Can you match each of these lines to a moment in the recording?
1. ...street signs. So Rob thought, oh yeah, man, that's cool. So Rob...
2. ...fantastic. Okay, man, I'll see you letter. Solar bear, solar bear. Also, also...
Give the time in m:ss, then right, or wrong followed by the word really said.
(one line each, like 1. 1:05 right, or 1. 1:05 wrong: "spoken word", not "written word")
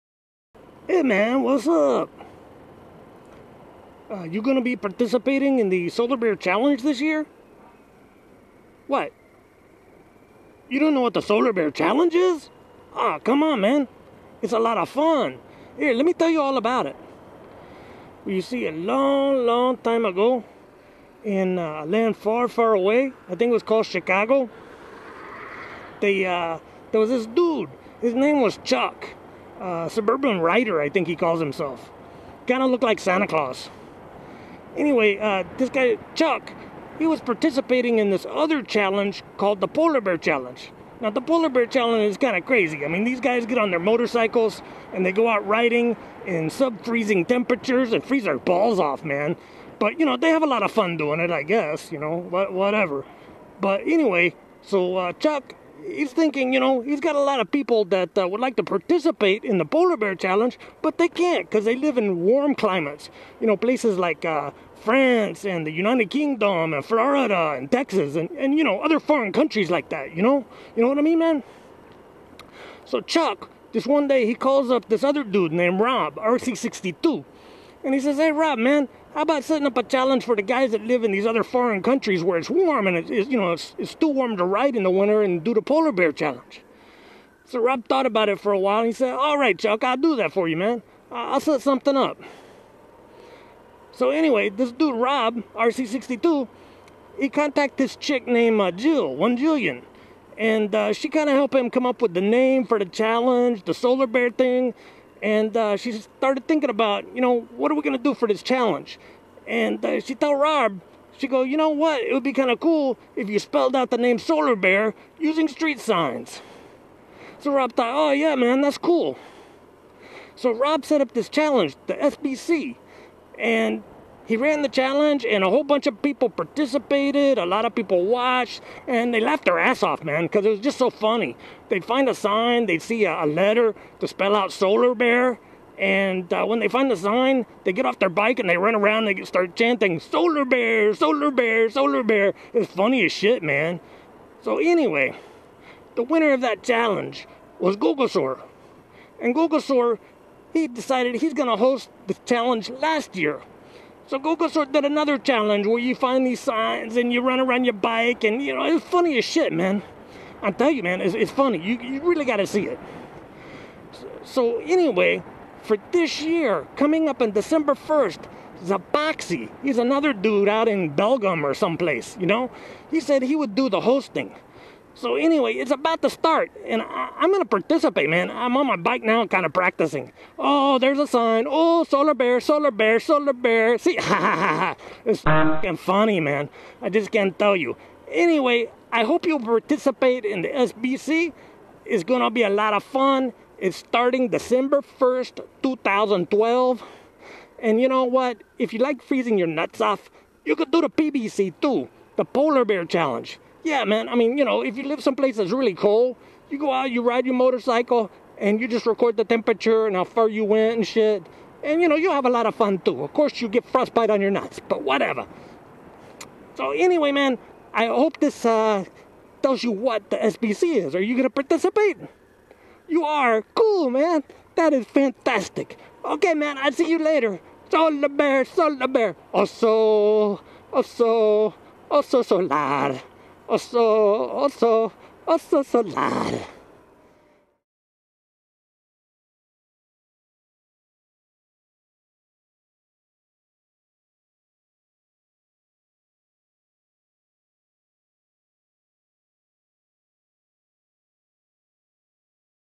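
1. 1:55 right
2. 3:44 wrong: "later", not "letter".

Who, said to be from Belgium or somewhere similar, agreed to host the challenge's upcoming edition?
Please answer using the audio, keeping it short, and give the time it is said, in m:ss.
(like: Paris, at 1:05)
Zepoxi, at 2:48.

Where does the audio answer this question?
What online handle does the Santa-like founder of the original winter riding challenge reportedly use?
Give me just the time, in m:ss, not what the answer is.
0:29.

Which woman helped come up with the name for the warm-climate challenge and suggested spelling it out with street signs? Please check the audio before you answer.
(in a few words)
Jillian.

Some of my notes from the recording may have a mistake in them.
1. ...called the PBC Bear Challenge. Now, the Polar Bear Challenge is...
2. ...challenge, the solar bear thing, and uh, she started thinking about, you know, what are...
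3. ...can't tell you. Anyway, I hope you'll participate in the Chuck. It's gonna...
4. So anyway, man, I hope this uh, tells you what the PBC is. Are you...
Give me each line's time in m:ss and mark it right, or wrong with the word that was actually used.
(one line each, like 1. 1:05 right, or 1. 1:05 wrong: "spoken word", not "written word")
1. 0:39 wrong: "Polar", not "PBC"
2. 1:42 right
3. 3:07 wrong: "SBC", not "Chuck"
4. 3:36 wrong: "SBC", not "PBC".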